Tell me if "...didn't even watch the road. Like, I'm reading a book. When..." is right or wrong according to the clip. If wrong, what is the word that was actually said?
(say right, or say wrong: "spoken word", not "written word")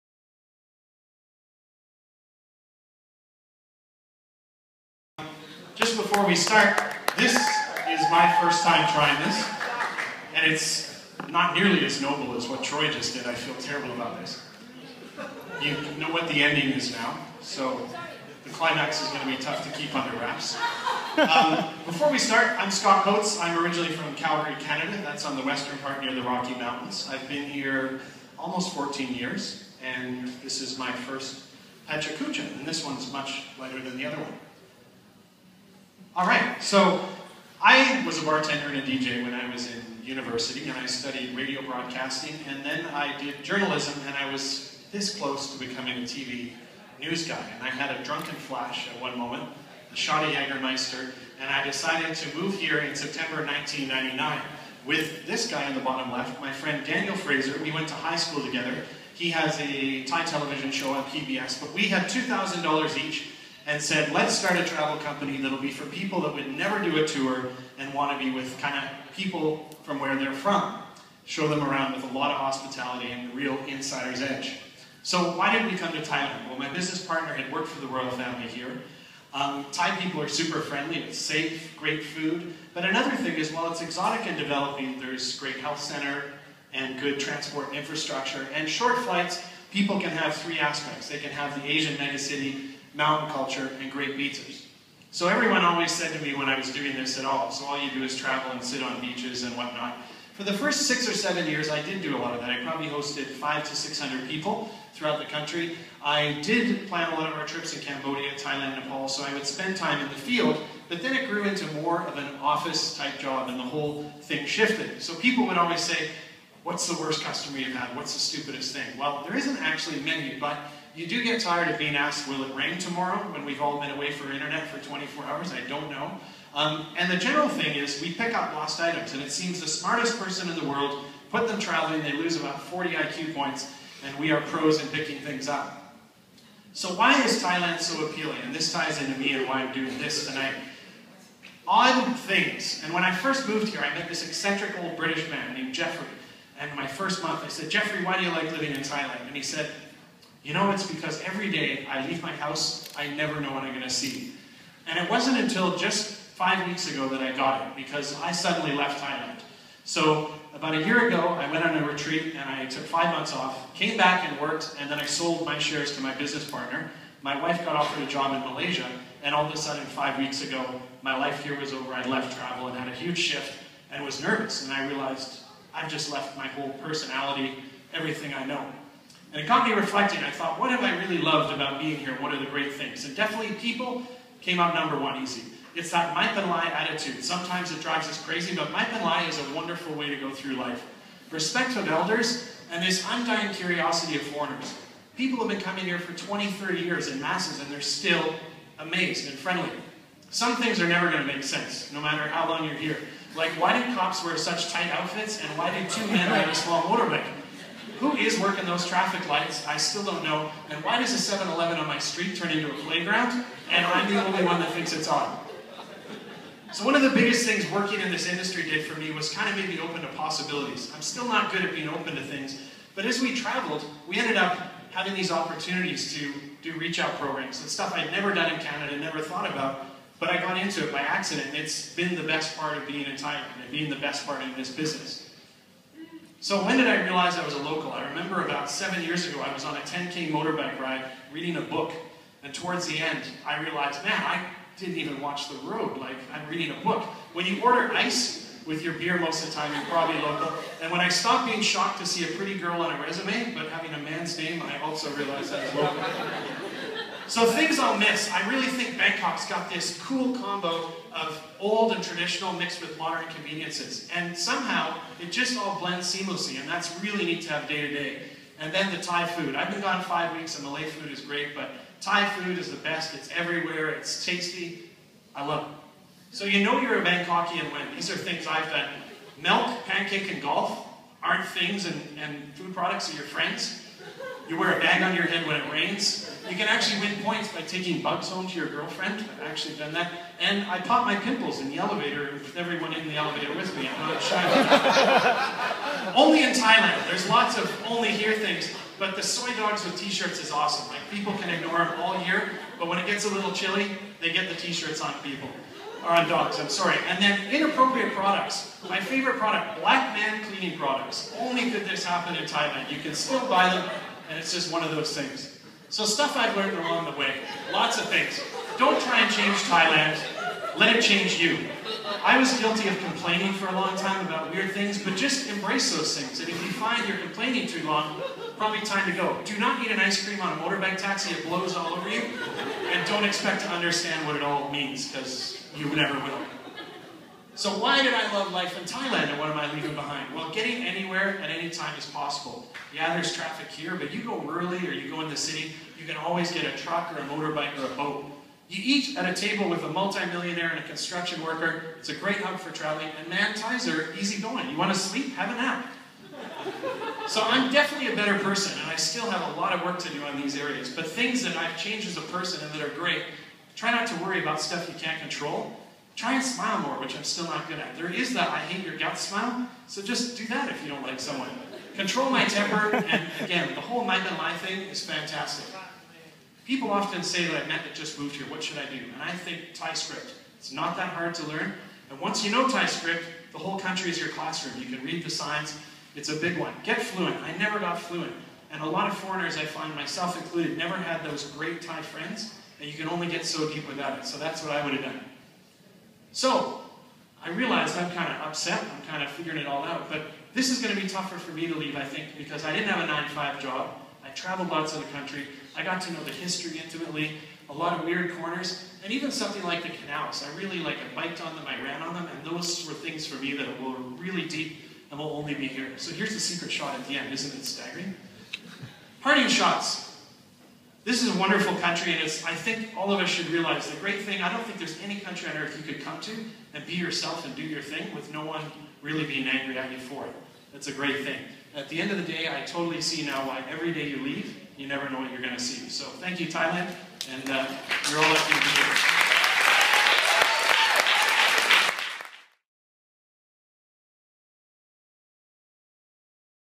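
right.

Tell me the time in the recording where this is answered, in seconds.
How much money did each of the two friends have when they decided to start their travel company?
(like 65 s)
62 s.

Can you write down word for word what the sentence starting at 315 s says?
So stuff I've learned along the way, lots of things.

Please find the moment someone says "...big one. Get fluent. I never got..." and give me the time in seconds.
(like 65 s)
386 s.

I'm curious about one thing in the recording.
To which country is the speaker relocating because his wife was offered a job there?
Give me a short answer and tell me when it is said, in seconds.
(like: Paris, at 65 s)
Malaysia, at 168 s.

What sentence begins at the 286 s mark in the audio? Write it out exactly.
You can actually win points by taking bugs home to your girlfriend.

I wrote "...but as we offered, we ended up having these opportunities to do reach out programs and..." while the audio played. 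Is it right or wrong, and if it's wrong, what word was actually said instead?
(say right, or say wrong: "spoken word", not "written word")
wrong: "traveled", not "offered".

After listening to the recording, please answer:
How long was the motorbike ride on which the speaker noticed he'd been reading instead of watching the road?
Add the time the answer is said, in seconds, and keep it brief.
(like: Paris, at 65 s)
10K, at 239 s.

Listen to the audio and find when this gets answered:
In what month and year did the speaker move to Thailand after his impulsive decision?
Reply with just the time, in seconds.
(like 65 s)
52 s.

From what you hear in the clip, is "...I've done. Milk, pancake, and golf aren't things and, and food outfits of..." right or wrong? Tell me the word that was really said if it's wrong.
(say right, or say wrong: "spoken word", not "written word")
wrong: "products", not "outfits".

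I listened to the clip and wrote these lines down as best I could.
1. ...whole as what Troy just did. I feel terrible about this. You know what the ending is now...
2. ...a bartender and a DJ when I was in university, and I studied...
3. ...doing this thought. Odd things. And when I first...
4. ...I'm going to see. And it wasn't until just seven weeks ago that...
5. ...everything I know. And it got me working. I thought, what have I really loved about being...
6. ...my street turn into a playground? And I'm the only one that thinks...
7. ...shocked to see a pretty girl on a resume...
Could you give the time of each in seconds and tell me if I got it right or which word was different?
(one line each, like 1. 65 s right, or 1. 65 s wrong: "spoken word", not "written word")
1. 11 s wrong: "noble", not "whole"
2. 38 s right
3. 139 s wrong: "tonight", not "thought"
4. 153 s wrong: "five", not "seven"
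5. 177 s wrong: "reflecting", not "working"
6. 211 s right
7. 251 s right.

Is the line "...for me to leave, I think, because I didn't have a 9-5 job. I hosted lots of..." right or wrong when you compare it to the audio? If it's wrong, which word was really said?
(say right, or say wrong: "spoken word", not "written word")
wrong: "traveled", not "hosted".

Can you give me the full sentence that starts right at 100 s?
For the first six or seven years, I did do a lot of that.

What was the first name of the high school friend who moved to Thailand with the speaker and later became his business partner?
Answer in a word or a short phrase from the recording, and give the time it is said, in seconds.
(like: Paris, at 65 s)
Daniel, at 56 s.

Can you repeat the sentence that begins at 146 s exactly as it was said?
And my first month, I said, Jeffrey, why do you like living in Thailand?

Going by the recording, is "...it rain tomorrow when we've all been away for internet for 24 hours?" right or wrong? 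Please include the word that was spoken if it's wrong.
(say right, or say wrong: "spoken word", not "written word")
right.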